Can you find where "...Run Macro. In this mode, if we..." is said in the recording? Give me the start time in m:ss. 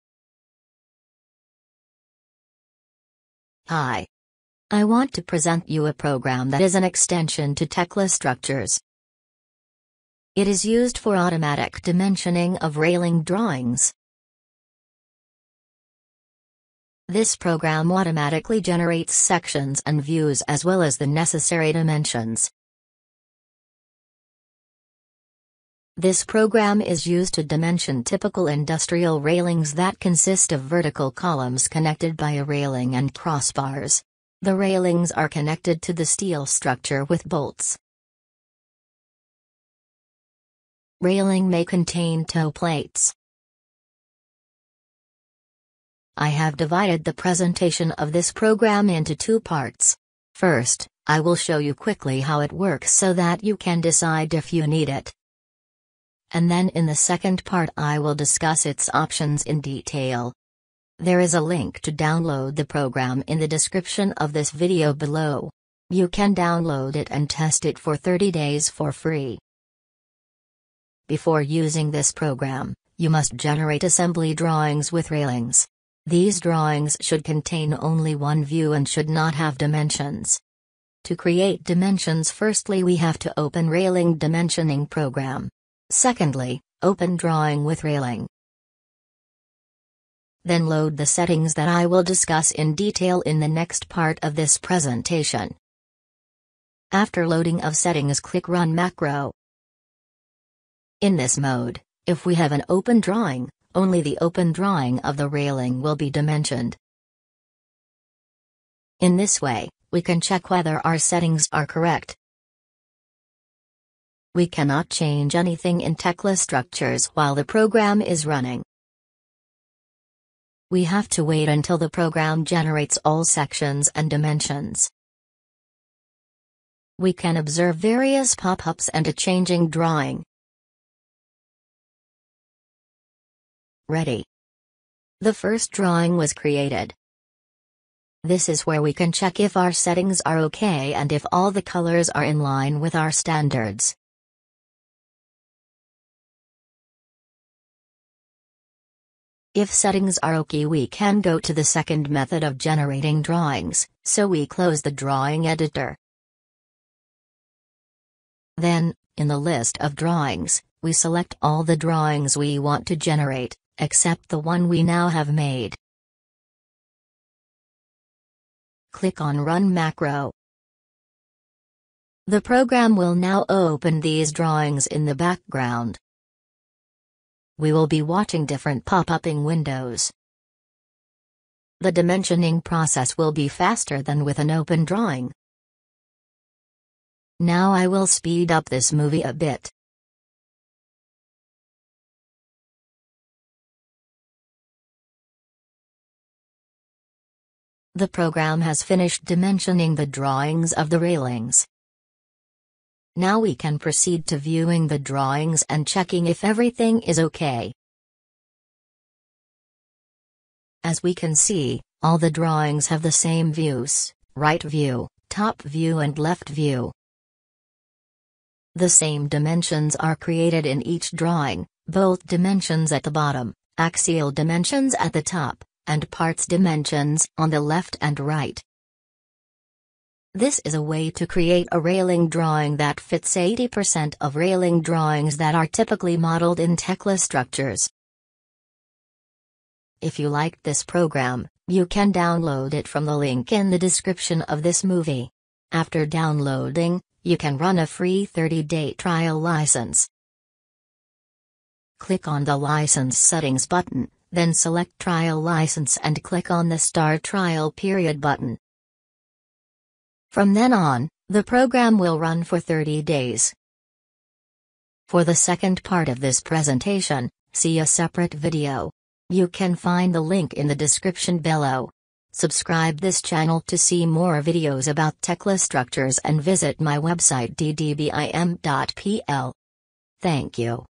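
1:38.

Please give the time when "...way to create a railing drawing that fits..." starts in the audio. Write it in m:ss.
3:50.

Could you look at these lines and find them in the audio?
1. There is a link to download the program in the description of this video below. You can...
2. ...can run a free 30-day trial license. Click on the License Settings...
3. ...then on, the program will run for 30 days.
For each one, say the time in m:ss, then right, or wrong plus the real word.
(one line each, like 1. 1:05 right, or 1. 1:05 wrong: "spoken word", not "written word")
1. 1:00 right
2. 4:07 right
3. 4:20 right.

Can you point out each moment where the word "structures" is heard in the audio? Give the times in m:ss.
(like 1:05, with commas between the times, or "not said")
0:08, 0:36, 1:56, 3:57, 4:35.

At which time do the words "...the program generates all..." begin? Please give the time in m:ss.
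2:01.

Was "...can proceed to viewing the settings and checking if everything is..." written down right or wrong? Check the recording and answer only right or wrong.
wrong.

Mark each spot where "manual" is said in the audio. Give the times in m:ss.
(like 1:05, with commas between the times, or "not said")
not said.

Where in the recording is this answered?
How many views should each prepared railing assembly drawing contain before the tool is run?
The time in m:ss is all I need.
1:17.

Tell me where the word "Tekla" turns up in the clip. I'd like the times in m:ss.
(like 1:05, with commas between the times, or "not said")
0:07, 1:55, 3:56, 4:35.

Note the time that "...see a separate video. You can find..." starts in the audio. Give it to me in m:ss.
4:27.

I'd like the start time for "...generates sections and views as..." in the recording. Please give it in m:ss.
0:18.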